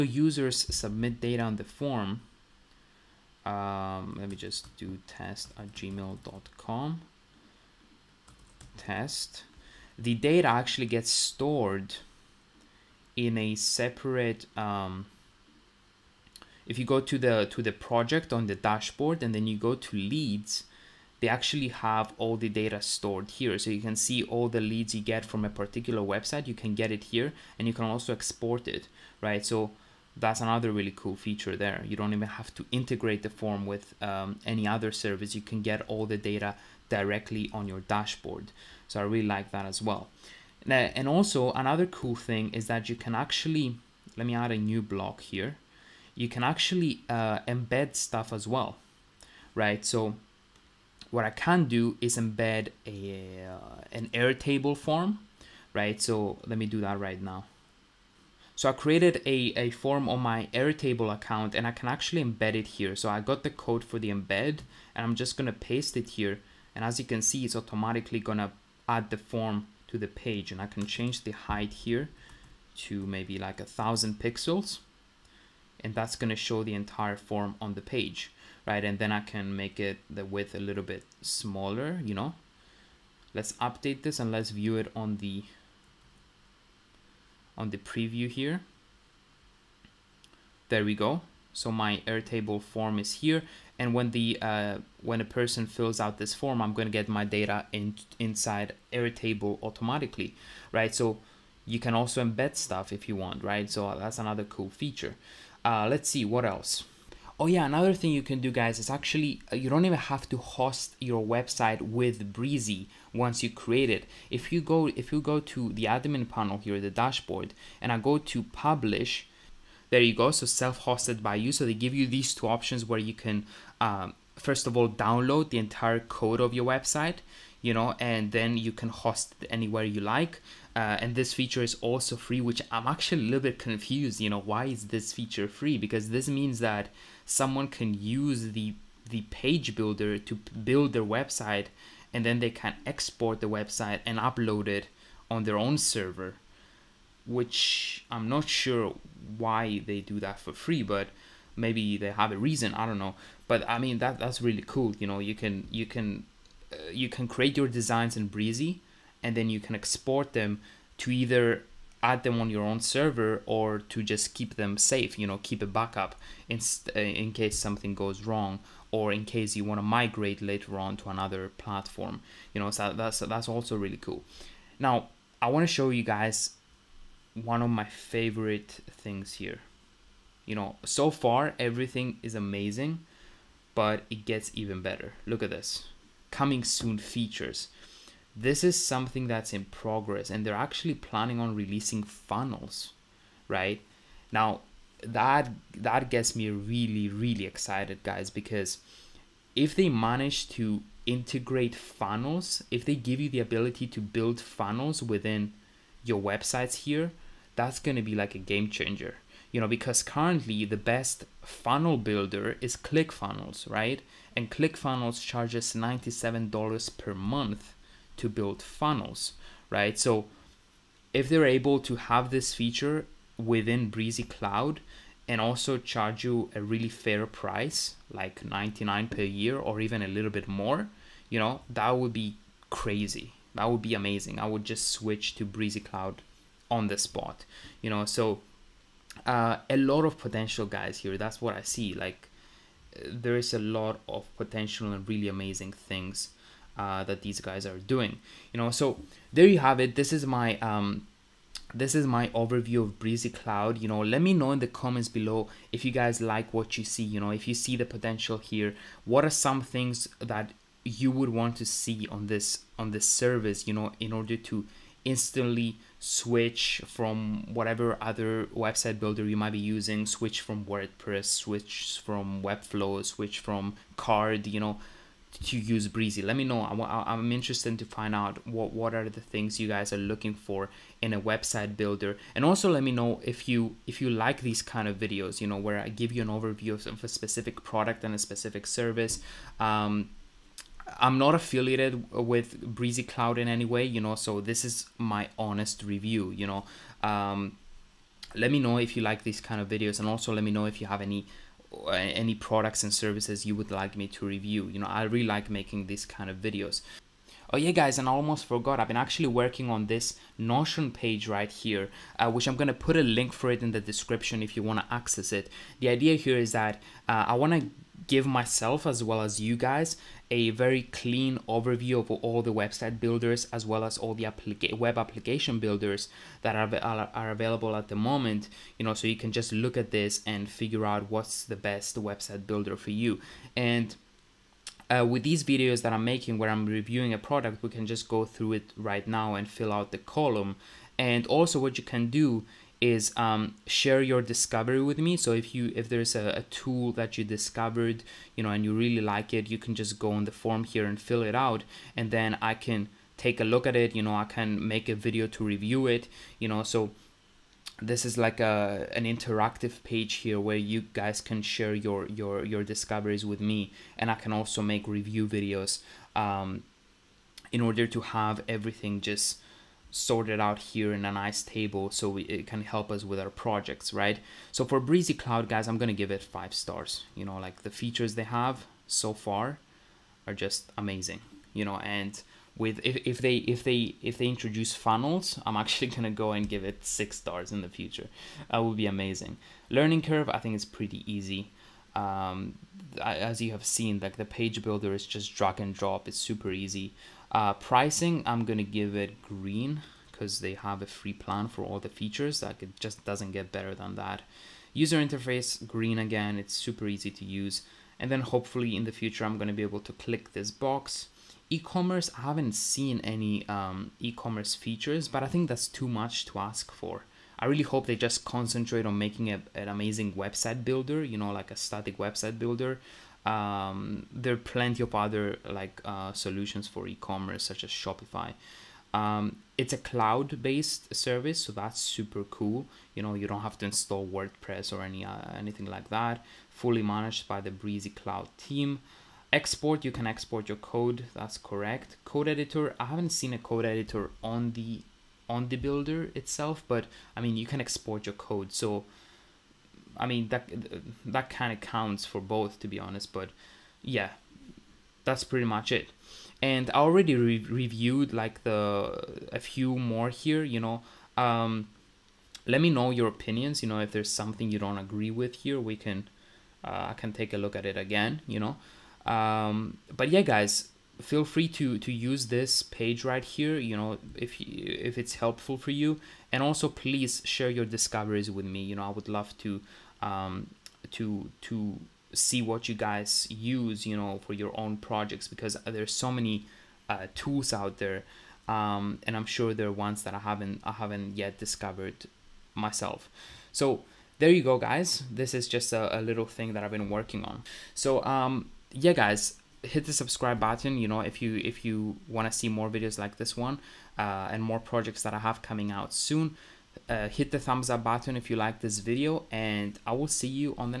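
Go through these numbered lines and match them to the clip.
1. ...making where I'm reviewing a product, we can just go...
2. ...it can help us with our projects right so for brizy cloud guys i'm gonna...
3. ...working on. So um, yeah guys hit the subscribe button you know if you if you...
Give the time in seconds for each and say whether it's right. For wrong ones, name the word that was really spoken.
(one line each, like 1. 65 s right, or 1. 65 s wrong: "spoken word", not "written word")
1. 336 s right
2. 372 s right
3. 496 s right.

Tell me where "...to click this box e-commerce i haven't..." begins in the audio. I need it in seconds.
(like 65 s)
409 s.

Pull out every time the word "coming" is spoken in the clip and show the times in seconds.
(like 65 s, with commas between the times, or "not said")
186 s, 505 s.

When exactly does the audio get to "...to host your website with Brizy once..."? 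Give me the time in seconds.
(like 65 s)
110 s.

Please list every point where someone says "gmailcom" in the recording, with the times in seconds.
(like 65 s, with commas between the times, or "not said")
5 s.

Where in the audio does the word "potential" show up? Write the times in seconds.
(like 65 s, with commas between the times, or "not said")
240 s, 244 s, 257 s.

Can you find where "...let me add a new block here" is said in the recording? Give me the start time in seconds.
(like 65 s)
44 s.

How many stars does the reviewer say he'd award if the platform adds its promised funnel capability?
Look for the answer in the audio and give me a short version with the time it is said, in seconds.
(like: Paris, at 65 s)
6, at 386 s.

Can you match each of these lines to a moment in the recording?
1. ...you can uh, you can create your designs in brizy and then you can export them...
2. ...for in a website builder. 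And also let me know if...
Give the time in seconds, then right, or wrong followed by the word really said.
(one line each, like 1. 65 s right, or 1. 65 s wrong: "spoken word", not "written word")
1. 155 s right
2. 280 s right.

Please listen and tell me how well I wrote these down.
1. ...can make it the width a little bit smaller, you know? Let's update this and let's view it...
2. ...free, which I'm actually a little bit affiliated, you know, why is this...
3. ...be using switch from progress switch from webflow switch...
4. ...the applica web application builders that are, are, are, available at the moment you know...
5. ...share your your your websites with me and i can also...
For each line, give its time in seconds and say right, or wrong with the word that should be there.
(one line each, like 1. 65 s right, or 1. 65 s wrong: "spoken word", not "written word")
1. 79 s right
2. 132 s wrong: "confused", not "affiliated"
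3. 269 s wrong: "wordpress", not "progress"
4. 324 s right
5. 361 s wrong: "discoveries", not "websites".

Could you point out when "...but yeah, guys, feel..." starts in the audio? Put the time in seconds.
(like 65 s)
469 s.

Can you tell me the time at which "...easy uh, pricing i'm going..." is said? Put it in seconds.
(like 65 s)
396 s.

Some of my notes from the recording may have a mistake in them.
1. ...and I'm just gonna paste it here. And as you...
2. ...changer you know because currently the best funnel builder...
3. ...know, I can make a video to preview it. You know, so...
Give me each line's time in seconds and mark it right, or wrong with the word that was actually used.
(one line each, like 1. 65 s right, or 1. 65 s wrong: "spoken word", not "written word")
1. 64 s right
2. 208 s right
3. 354 s wrong: "review", not "preview".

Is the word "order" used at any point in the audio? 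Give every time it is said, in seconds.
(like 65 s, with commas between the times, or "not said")
264 s, 367 s.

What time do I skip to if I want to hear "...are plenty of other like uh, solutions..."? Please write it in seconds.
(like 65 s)
424 s.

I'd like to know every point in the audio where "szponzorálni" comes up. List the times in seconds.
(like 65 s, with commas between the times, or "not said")
not said.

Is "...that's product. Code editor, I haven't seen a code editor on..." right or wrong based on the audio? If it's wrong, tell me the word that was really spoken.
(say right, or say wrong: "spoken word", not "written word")
wrong: "correct", not "product".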